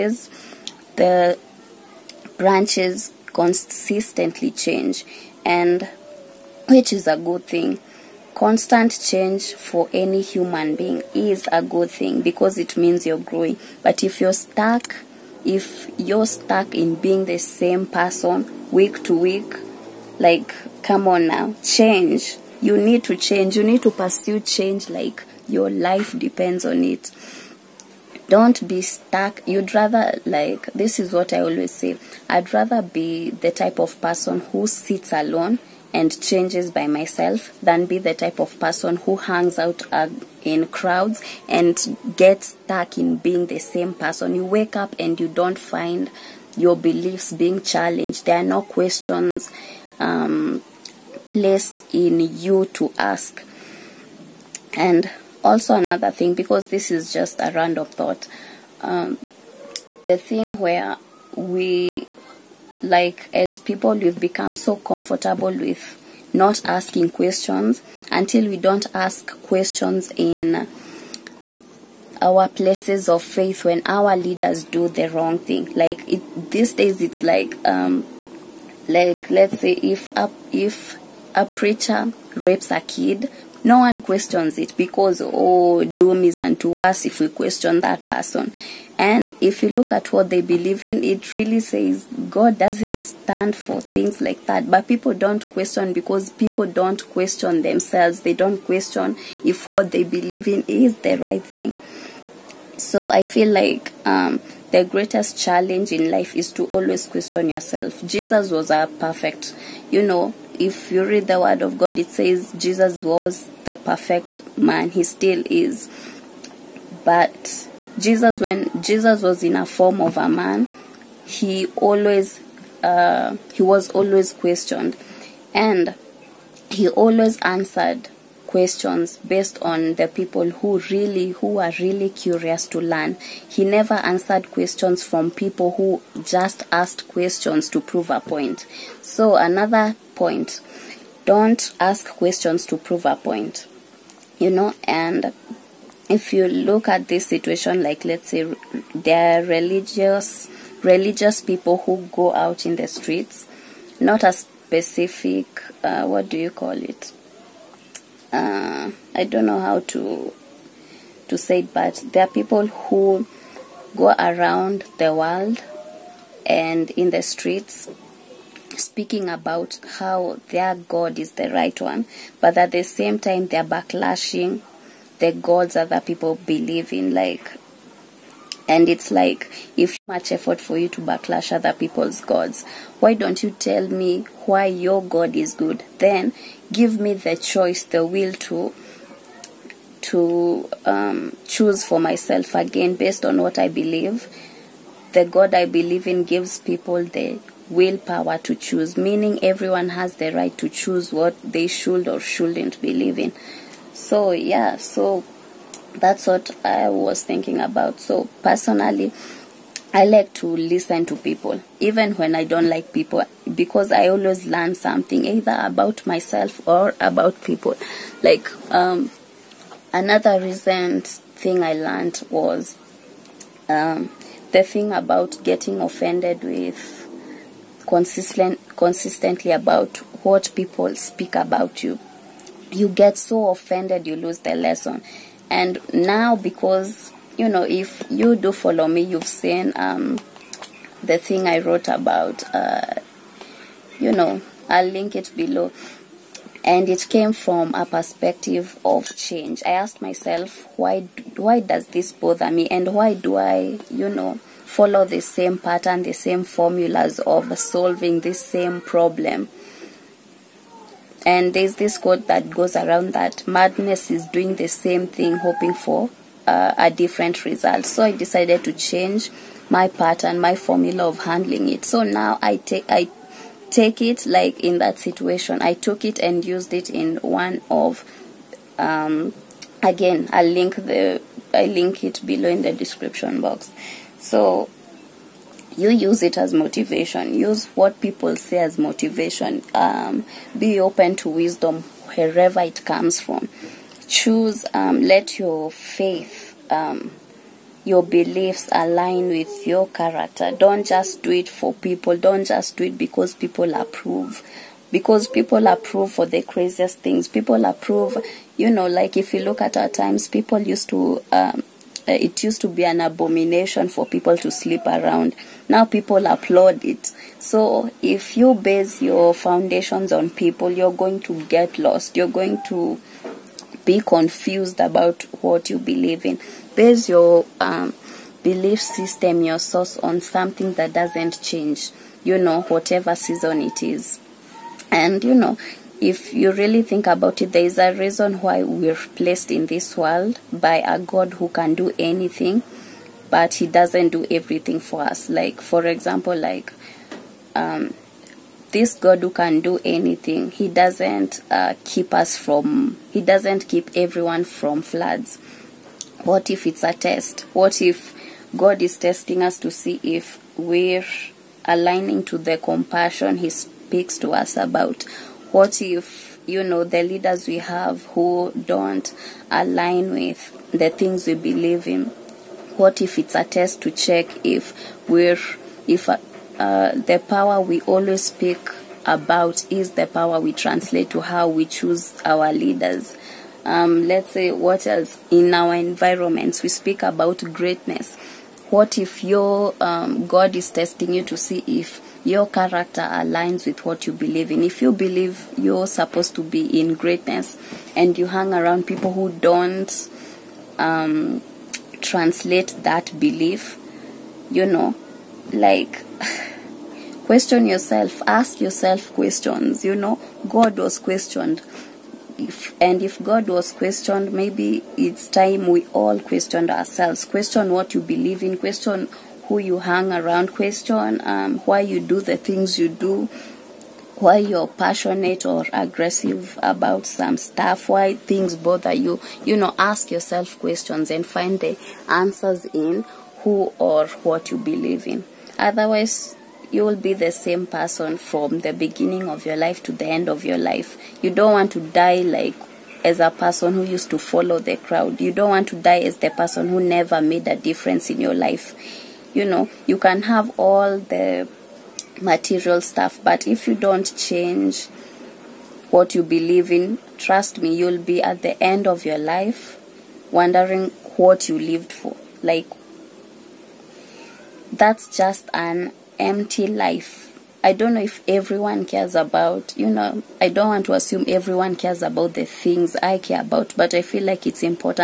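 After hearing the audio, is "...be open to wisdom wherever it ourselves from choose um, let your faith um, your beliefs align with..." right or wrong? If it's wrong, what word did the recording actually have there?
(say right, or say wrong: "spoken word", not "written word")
wrong: "comes", not "ourselves".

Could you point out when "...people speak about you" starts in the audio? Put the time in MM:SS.
03:50.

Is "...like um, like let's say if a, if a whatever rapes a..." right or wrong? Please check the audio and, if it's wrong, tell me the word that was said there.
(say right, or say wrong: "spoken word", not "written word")
wrong: "preacher", not "whatever".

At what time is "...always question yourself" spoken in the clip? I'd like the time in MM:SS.
01:46.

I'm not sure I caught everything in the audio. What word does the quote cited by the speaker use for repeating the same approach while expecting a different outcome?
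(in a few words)
madness.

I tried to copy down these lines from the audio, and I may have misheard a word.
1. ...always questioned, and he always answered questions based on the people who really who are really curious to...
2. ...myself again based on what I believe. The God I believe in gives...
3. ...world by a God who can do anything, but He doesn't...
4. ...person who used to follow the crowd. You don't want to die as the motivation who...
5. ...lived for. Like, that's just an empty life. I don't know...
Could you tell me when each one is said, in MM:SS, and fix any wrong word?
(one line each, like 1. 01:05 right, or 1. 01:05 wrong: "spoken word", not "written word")
1. 02:03 right
2. 03:11 right
3. 05:39 right
4. 07:23 wrong: "person", not "motivation"
5. 07:41 right.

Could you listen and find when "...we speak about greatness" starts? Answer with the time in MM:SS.
06:26.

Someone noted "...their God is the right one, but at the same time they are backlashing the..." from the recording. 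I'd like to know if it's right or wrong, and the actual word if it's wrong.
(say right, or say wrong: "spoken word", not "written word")
right.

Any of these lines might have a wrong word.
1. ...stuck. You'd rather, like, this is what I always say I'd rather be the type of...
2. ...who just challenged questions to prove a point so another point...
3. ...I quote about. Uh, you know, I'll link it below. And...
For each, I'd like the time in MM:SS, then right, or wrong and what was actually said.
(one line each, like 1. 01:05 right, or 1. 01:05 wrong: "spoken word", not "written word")
1. 00:28 right
2. 02:15 wrong: "asked", not "challenged"
3. 04:01 wrong: "wrote", not "quote".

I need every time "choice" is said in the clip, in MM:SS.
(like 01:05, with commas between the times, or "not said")
03:07.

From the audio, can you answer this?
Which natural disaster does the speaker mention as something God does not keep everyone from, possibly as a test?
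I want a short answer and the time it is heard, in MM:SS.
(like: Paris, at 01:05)
floods, at 05:54.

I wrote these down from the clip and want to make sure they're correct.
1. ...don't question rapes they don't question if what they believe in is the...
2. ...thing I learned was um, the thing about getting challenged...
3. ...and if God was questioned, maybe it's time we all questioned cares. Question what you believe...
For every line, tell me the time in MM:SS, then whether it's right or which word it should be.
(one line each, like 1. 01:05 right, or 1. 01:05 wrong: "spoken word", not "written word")
1. 01:36 wrong: "themselves", not "rapes"
2. 03:41 wrong: "offended", not "challenged"
3. 06:52 wrong: "ourselves", not "cares".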